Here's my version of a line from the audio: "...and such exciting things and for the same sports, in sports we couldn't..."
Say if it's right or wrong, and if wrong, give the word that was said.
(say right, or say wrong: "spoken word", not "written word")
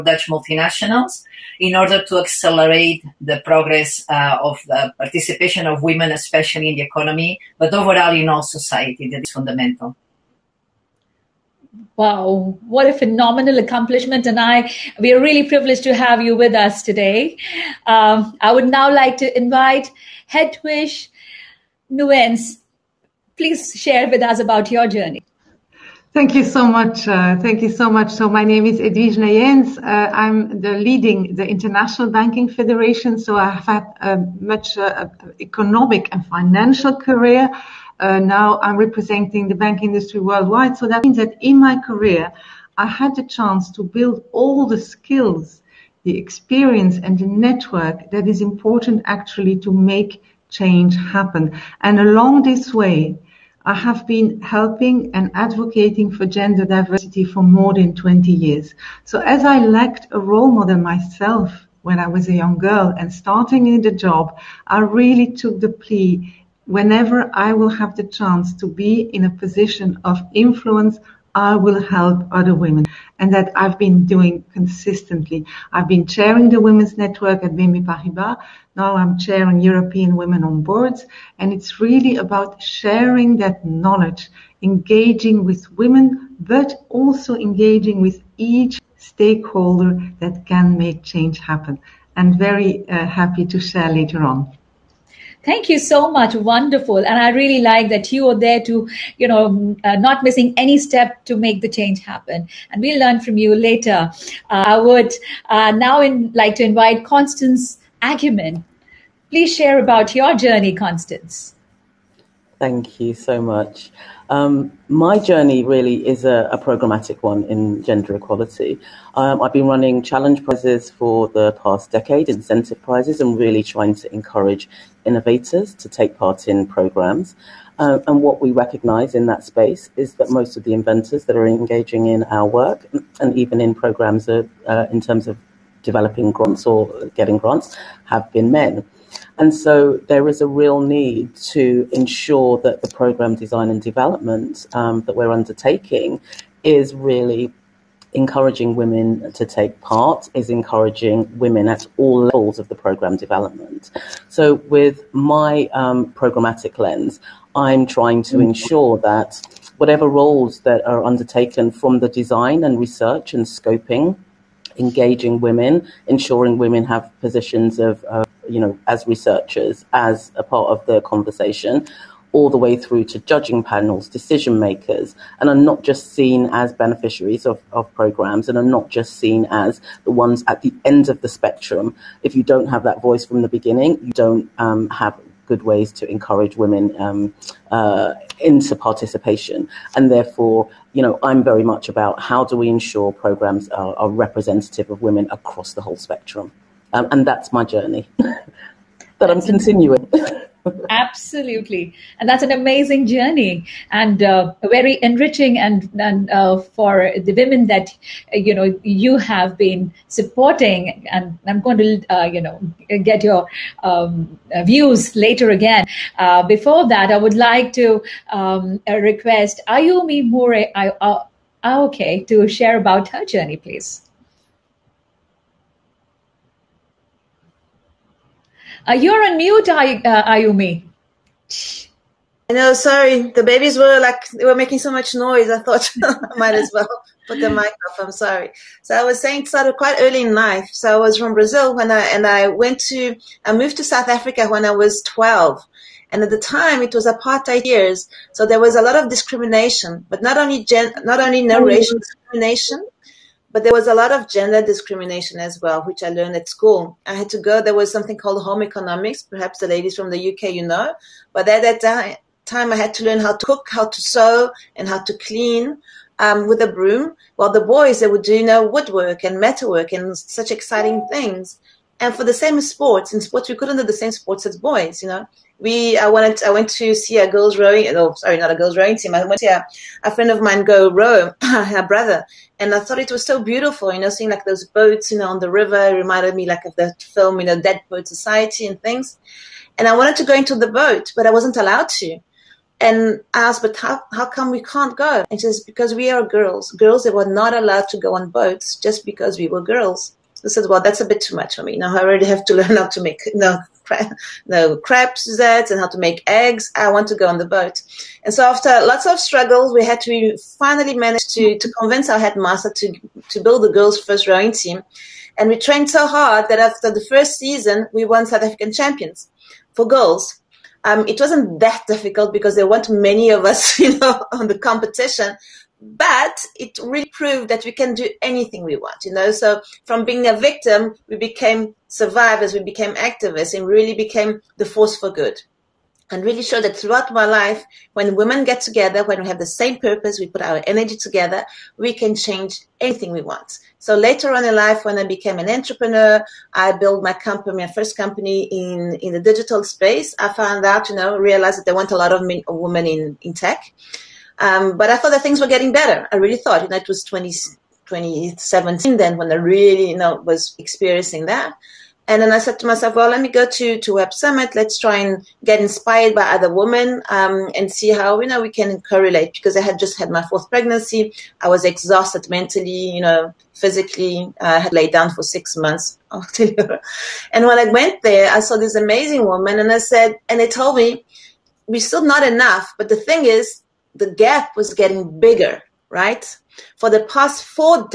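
right.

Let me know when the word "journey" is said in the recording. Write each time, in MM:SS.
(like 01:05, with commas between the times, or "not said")
00:24, 01:50, 01:55, 03:17, 03:23, 03:43.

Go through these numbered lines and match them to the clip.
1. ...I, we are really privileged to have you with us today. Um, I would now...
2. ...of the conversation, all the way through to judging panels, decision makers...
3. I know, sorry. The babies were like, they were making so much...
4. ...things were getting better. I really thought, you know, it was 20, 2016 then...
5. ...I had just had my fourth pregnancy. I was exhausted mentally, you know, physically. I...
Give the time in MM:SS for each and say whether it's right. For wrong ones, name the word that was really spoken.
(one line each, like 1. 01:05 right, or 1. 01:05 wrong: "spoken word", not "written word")
1. 00:14 right
2. 02:50 right
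3. 03:52 right
4. 05:55 wrong: "2017", not "2016"
5. 06:09 right.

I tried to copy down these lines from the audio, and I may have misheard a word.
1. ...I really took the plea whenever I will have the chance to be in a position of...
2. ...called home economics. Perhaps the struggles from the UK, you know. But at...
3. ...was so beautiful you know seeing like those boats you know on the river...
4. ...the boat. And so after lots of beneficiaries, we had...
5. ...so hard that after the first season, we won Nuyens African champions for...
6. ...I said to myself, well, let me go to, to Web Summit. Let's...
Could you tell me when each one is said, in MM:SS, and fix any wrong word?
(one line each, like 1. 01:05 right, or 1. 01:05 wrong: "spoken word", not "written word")
1. 01:04 right
2. 04:18 wrong: "ladies", not "struggles"
3. 04:43 right
4. 05:07 wrong: "struggles", not "beneficiaries"
5. 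05:15 wrong: "South", not "Nuyens"
6. 06:02 right.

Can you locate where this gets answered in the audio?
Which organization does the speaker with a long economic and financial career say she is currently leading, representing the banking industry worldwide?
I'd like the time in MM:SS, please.
00:31.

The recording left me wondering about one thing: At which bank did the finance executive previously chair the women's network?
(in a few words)
BNP Paribas.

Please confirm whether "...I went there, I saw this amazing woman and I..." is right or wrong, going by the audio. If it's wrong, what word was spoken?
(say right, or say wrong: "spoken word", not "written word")
right.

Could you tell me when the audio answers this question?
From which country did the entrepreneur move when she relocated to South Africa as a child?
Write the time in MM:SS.
04:01.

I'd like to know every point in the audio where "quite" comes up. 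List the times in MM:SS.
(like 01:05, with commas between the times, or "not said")
03:59.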